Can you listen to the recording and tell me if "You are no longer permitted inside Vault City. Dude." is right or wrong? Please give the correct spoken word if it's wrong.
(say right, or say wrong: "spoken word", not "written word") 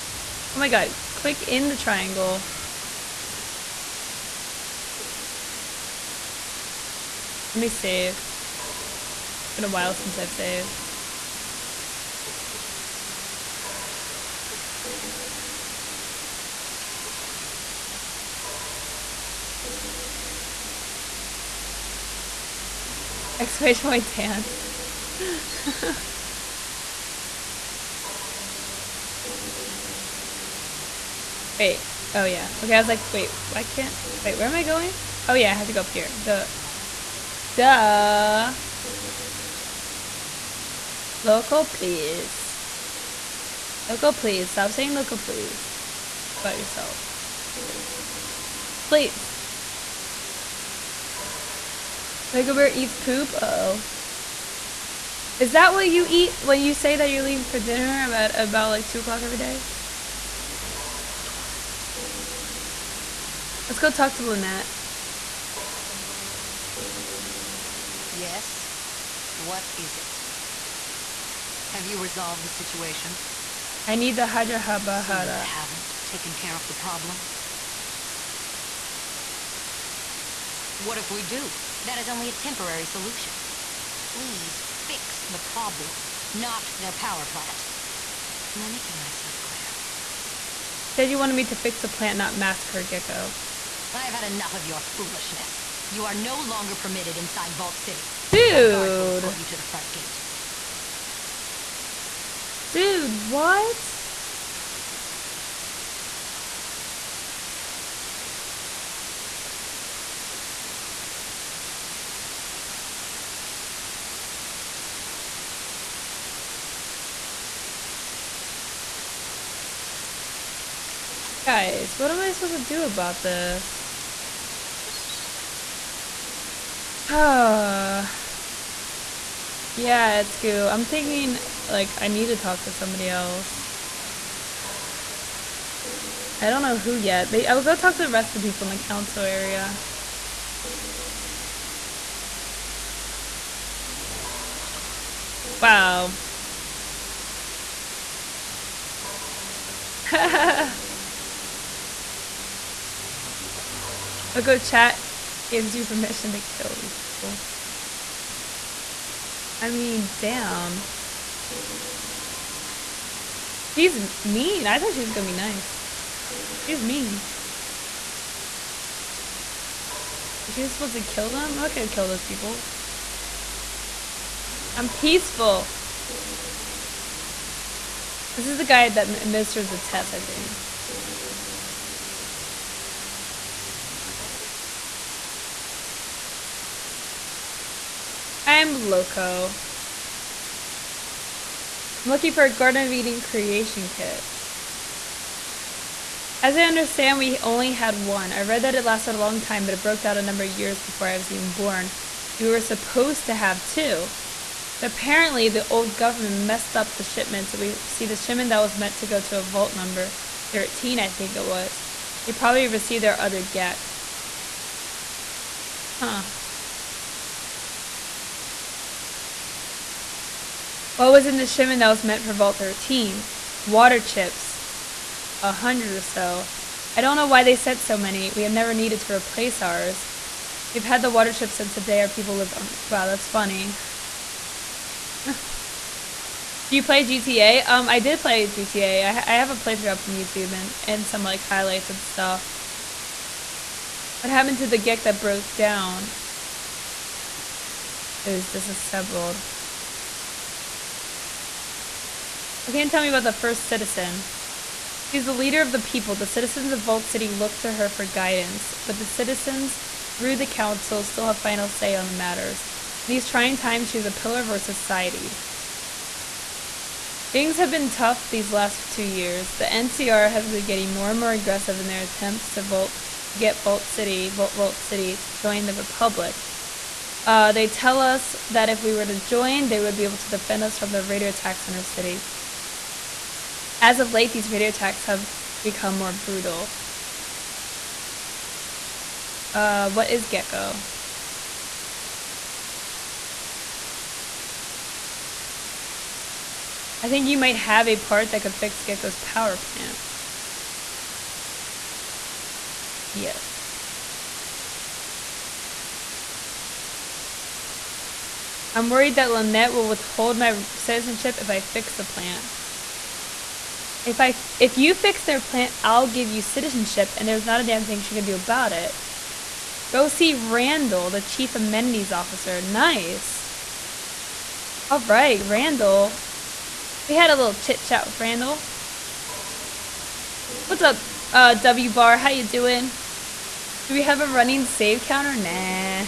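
right.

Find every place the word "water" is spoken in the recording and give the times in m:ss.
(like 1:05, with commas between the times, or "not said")
3:43, 3:51.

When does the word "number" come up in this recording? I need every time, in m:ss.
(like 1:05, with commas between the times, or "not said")
3:20, 3:29.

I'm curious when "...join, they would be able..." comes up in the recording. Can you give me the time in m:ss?
4:39.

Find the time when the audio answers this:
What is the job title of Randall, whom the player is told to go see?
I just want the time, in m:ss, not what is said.
5:21.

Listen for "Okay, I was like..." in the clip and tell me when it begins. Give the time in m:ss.
0:32.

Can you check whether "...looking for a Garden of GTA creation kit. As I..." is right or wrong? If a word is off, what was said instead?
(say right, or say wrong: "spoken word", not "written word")
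wrong: "Eden", not "GTA".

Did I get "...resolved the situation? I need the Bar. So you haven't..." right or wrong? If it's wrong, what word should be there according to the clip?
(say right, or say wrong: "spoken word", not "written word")
wrong: "Hajarhabahara", not "Bar".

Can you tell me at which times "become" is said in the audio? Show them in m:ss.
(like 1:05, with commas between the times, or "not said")
4:45.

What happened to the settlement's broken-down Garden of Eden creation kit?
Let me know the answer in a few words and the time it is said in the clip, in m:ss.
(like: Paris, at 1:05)
It was disassembled, at 4:08.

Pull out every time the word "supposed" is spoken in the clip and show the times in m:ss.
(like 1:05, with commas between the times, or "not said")
2:02, 3:22.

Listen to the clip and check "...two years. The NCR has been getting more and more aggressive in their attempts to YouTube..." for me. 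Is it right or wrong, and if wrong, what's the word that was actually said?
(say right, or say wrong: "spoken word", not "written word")
wrong: "Vault", not "YouTube".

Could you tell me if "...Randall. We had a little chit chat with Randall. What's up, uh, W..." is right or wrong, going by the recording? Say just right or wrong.
right.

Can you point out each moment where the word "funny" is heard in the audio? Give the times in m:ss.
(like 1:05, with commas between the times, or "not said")
3:53.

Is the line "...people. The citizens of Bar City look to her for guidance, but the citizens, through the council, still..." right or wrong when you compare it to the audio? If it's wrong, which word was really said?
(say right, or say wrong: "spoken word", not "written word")
wrong: "Vault", not "Bar".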